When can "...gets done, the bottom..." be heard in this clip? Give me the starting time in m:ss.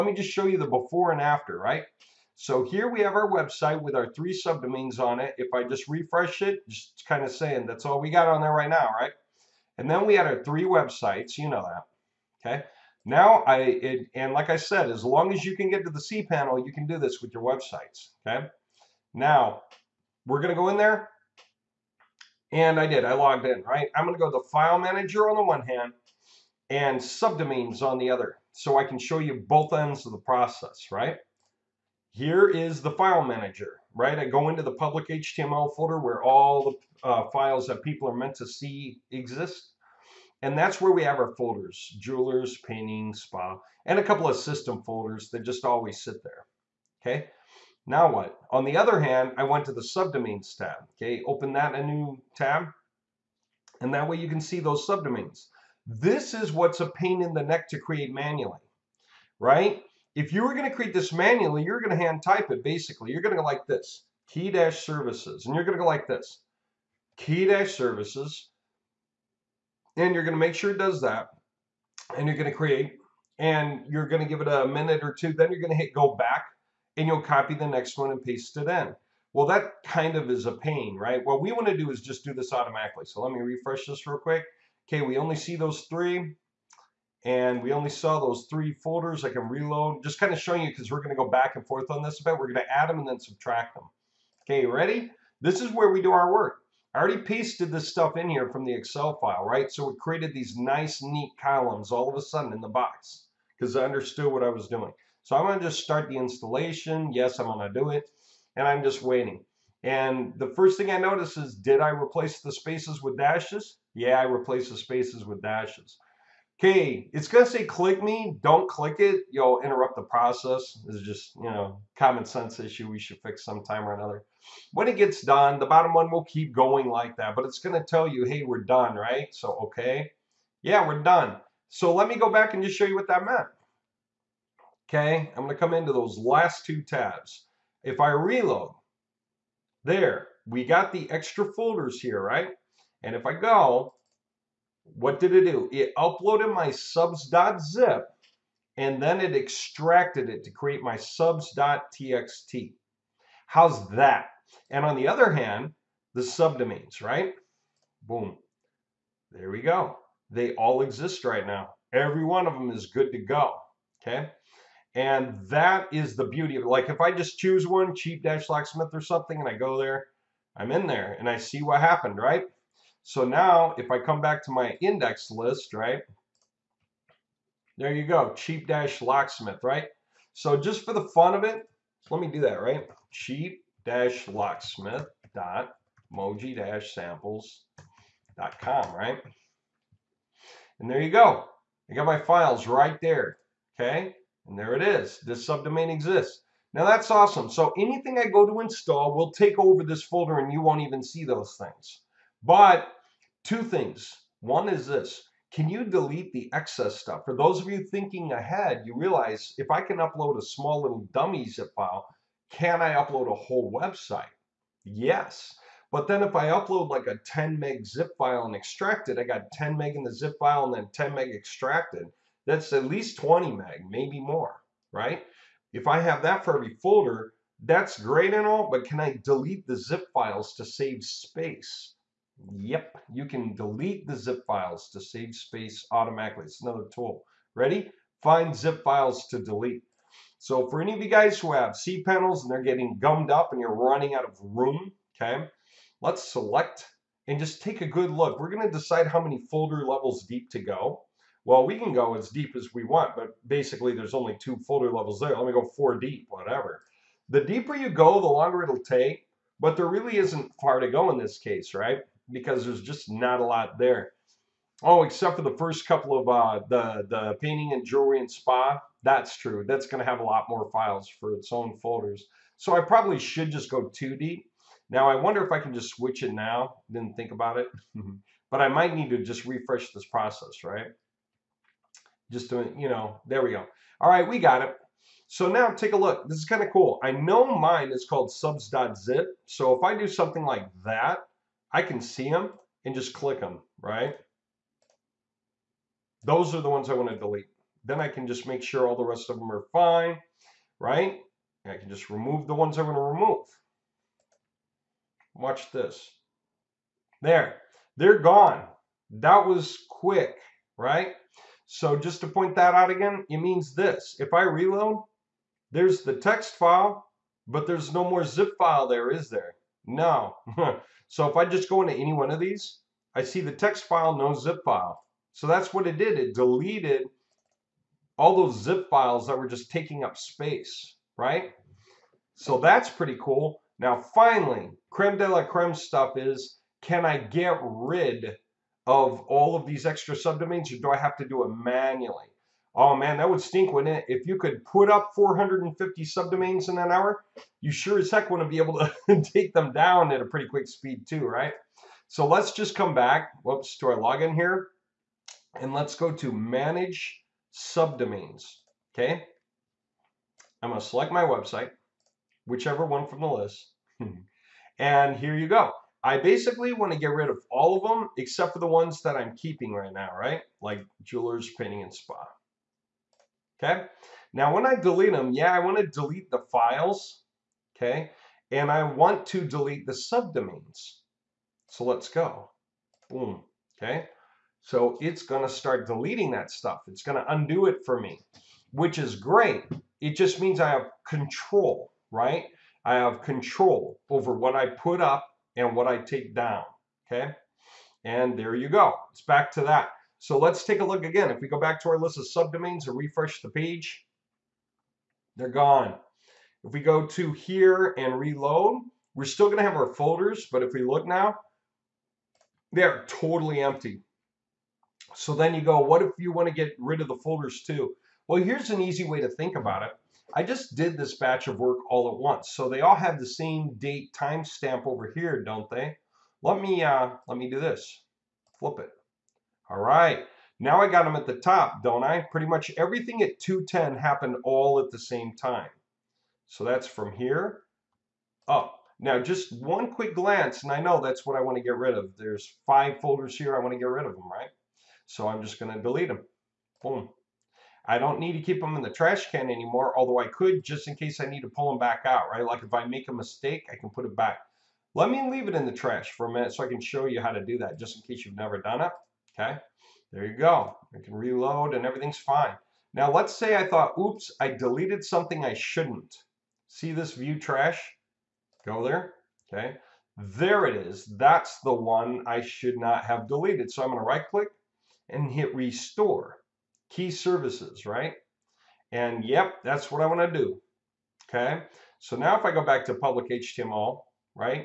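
2:04.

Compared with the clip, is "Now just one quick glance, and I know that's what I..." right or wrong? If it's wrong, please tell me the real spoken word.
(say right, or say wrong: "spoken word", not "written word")
right.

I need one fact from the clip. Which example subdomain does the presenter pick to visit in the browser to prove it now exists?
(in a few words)
cheap-locksmith.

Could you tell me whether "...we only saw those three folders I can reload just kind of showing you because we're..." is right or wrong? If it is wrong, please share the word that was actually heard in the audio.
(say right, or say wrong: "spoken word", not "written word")
right.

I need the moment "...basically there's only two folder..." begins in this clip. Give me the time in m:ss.
4:13.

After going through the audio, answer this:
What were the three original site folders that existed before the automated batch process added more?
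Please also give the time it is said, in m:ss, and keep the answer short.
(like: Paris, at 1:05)
jewelers, painting, spa, at 0:41.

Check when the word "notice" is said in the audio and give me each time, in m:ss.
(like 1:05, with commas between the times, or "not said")
1:50.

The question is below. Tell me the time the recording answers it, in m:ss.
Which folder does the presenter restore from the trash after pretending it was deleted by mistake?
7:56.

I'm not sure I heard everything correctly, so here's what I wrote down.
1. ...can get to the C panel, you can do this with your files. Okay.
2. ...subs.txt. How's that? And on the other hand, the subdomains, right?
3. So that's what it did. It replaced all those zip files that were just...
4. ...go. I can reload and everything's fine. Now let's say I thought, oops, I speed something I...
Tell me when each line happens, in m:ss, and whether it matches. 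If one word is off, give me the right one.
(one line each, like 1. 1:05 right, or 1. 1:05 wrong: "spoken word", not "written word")
1. 0:15 wrong: "websites", not "files"
2. 2:30 right
3. 5:25 wrong: "deleted", not "replaced"
4. 7:40 wrong: "deleted", not "speed".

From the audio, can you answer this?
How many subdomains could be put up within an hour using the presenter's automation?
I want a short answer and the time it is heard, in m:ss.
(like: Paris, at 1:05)
450, at 5:45.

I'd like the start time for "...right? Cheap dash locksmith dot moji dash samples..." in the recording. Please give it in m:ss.
3:02.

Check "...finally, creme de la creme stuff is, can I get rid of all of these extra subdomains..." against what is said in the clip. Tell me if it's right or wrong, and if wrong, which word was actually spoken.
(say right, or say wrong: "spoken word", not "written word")
right.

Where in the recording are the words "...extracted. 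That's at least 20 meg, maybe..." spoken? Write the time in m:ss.
3:41.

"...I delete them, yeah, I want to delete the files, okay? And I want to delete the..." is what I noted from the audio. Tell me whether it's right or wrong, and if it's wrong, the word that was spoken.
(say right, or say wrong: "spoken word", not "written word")
right.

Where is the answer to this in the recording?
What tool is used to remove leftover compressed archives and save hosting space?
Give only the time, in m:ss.
3:58.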